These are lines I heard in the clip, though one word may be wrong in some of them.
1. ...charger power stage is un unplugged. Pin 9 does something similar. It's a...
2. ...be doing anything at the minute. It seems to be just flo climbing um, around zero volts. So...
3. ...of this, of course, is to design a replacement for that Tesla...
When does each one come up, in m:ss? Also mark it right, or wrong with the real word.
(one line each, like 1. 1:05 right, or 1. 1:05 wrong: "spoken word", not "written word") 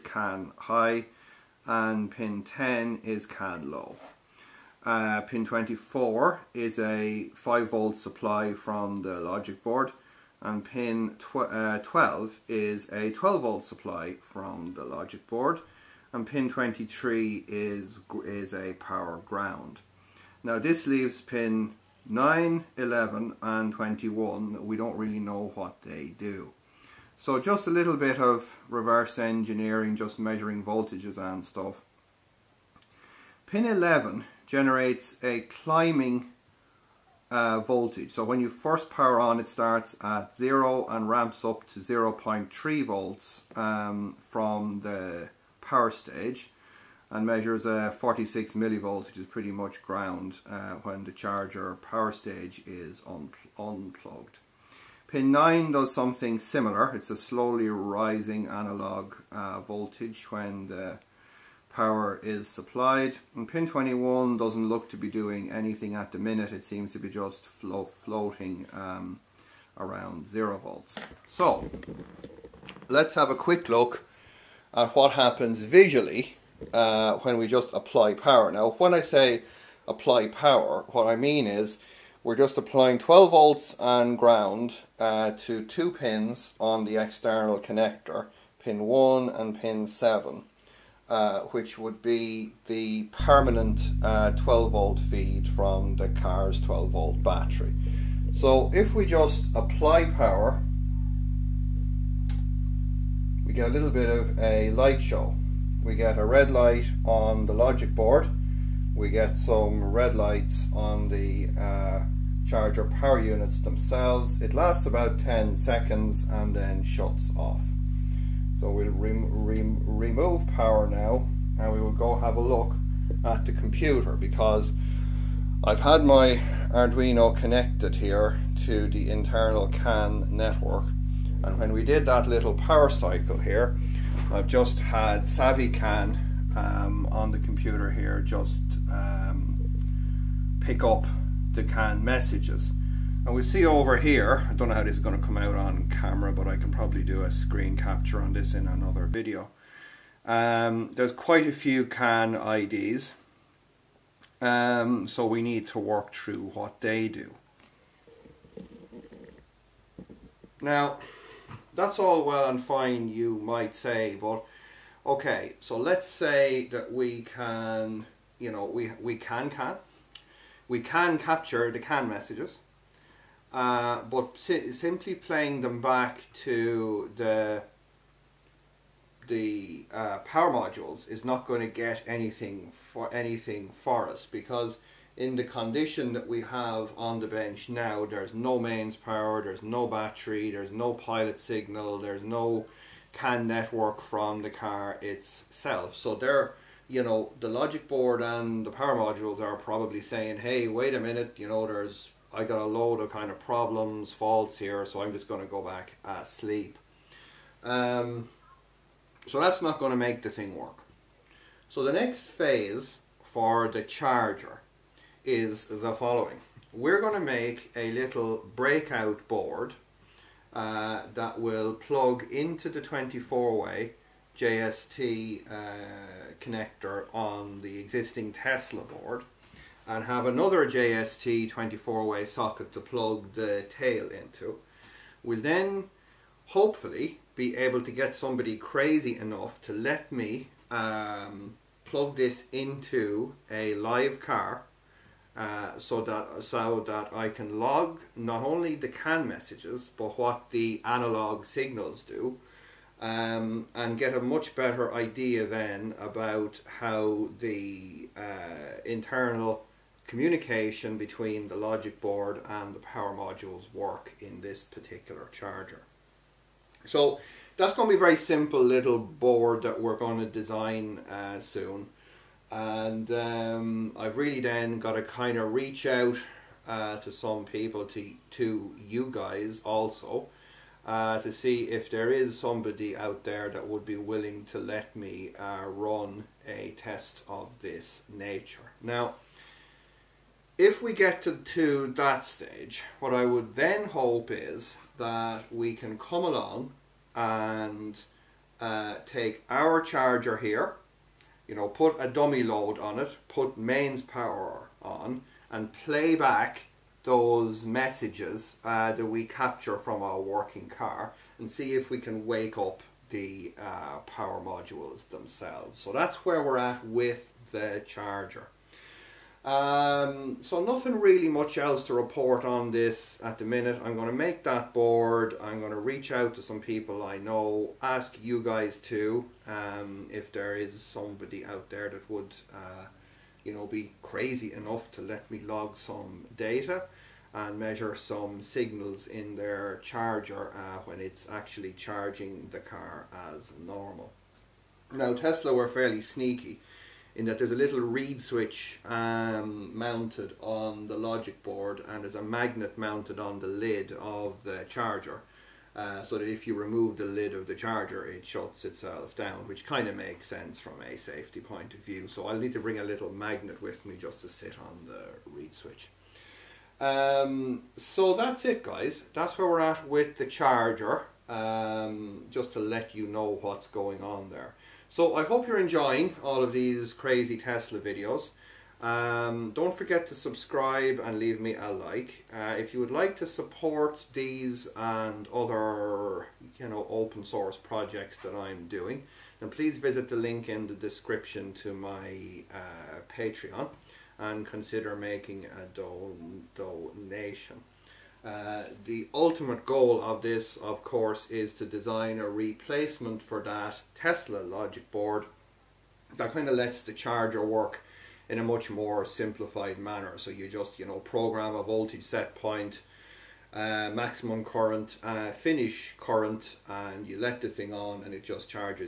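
1. 0:51 right
2. 1:04 wrong: "floating", not "climbing"
3. 6:40 right.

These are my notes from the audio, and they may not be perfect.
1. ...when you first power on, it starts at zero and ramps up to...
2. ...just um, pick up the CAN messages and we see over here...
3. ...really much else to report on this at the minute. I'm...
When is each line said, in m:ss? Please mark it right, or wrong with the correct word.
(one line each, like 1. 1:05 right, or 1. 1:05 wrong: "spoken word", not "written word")
1. 0:38 right
2. 2:18 right
3. 5:21 right.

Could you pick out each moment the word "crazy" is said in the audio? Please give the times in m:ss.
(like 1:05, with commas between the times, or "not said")
3:58, 5:34, 6:16.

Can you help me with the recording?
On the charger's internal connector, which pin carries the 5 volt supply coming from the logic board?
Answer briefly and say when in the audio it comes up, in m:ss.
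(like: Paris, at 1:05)
24, at 0:05.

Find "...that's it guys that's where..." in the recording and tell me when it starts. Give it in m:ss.
6:08.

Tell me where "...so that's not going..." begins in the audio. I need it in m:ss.
3:29.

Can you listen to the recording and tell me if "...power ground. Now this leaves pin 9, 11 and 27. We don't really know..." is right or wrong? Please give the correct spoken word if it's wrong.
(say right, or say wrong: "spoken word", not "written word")
wrong: "21", not "27".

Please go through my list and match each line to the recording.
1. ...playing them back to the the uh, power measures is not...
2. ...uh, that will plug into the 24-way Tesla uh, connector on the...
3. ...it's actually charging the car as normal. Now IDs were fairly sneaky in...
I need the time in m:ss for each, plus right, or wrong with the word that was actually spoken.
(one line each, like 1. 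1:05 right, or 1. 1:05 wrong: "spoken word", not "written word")
1. 2:55 wrong: "modules", not "measures"
2. 3:40 wrong: "JST", not "Tesla"
3. 5:41 wrong: "Tesla", not "IDs".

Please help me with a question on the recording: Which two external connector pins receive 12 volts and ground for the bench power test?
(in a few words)
1 and 7.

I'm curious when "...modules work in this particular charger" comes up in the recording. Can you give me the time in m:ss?
4:23.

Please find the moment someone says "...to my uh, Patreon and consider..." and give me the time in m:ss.
6:31.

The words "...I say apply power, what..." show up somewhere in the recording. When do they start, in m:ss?
1:18.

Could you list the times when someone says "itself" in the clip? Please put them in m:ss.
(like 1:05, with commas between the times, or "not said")
3:15, 5:58.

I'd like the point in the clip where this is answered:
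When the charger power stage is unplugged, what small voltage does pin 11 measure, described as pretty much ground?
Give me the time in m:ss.
0:47.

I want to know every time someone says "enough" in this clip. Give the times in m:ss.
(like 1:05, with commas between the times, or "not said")
3:59, 5:34.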